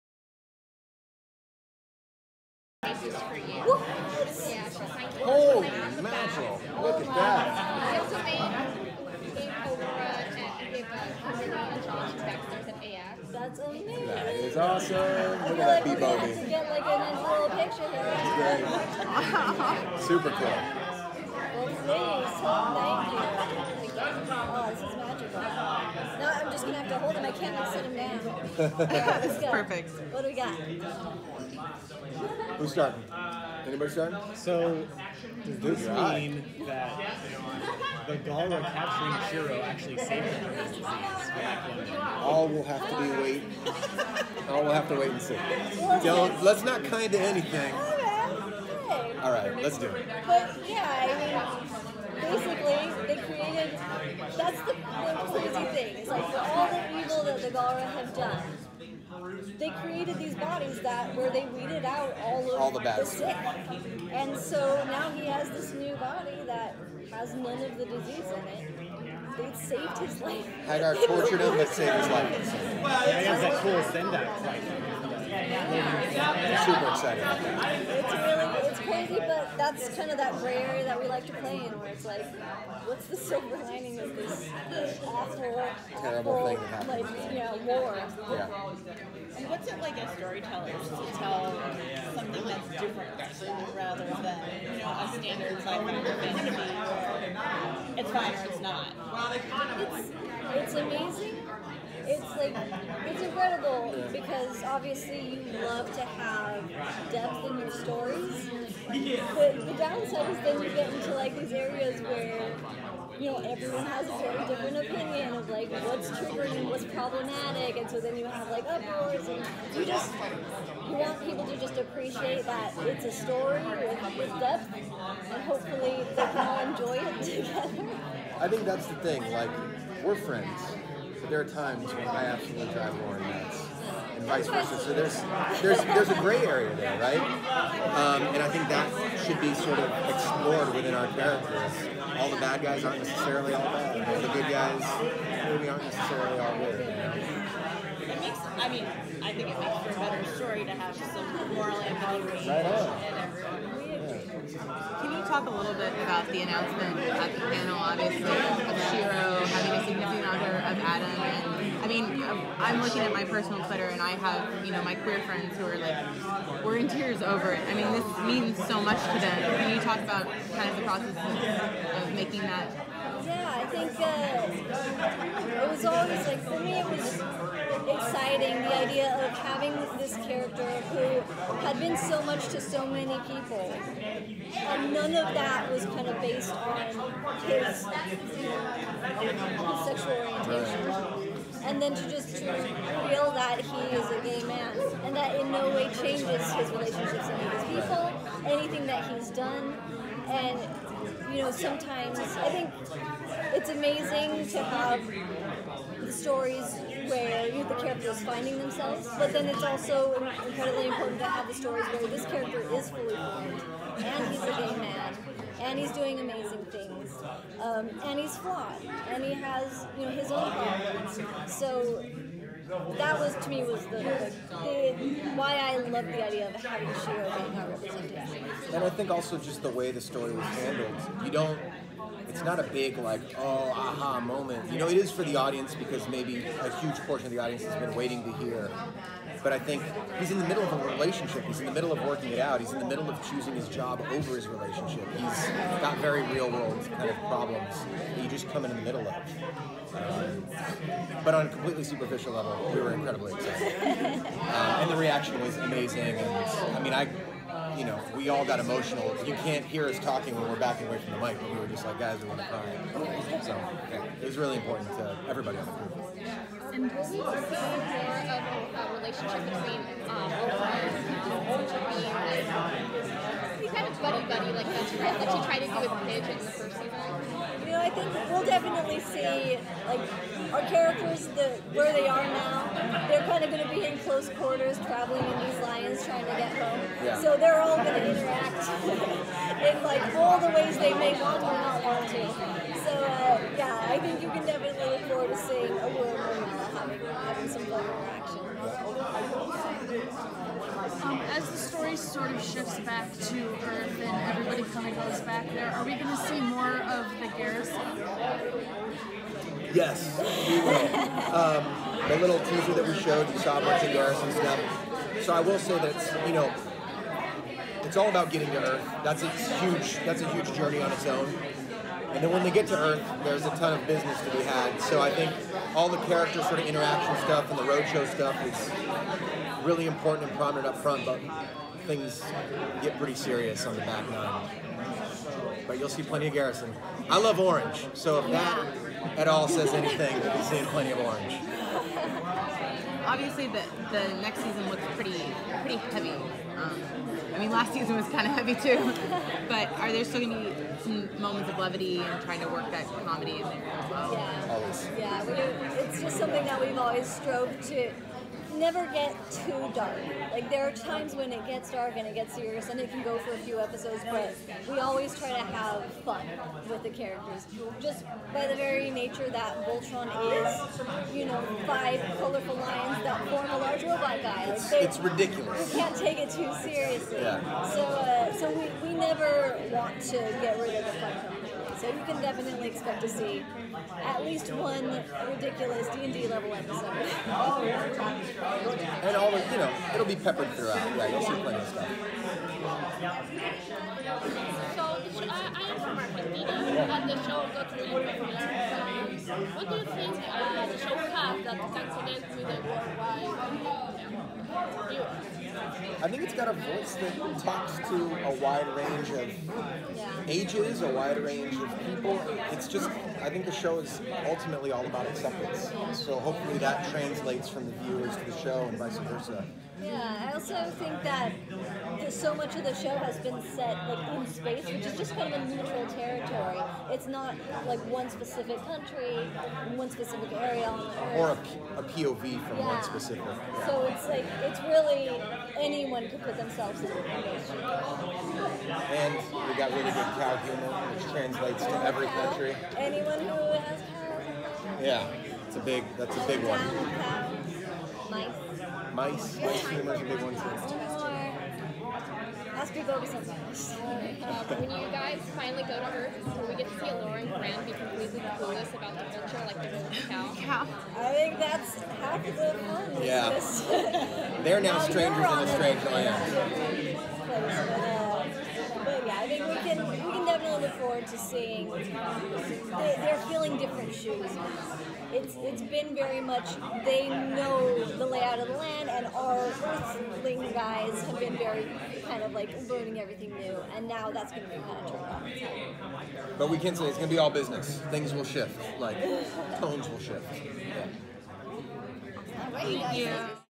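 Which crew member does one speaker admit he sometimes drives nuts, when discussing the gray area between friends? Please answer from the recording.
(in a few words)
Lauren.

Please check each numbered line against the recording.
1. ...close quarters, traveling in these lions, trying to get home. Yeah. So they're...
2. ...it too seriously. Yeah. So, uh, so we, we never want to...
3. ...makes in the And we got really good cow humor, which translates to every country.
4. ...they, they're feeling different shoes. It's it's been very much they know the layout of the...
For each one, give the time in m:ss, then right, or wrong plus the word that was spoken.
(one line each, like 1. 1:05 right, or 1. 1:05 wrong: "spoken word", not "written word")
1. 4:43 right
2. 6:16 right
3. 7:16 wrong: "themselves", not "makes"
4. 7:51 right.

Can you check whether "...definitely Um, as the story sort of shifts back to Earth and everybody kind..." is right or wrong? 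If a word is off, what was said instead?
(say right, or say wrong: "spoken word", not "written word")
right.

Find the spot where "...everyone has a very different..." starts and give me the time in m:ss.
1:53.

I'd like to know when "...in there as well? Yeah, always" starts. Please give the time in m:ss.
5:53.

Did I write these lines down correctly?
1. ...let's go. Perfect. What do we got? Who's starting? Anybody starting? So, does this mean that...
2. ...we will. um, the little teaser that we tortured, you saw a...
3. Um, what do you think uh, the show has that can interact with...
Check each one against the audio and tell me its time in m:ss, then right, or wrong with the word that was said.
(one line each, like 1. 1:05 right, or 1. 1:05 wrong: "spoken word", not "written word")
1. 0:28 right
2. 5:10 wrong: "showed", not "tortured"
3. 6:39 wrong: "connect", not "interact".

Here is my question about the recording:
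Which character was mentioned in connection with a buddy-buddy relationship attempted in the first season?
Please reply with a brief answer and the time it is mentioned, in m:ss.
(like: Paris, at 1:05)
Pidge, at 4:36.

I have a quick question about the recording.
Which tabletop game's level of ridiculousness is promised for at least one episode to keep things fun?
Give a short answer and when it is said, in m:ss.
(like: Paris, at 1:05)
D and D, at 6:25.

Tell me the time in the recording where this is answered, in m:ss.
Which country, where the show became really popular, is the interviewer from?
6:35.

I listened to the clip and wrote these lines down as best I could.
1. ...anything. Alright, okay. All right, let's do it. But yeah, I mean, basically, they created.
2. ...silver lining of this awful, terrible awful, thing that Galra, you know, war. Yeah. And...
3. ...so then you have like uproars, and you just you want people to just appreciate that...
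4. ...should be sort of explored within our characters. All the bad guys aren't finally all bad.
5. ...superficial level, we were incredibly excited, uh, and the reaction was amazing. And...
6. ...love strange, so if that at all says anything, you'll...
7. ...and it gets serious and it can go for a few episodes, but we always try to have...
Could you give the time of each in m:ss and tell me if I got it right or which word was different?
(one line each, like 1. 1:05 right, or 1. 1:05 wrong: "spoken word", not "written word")
1. 0:47 right
2. 1:23 wrong: "Like", not "Galra"
3. 1:57 right
4. 2:19 wrong: "necessarily", not "finally"
5. 4:11 right
6. 5:37 wrong: "orange", not "strange"
7. 6:01 right.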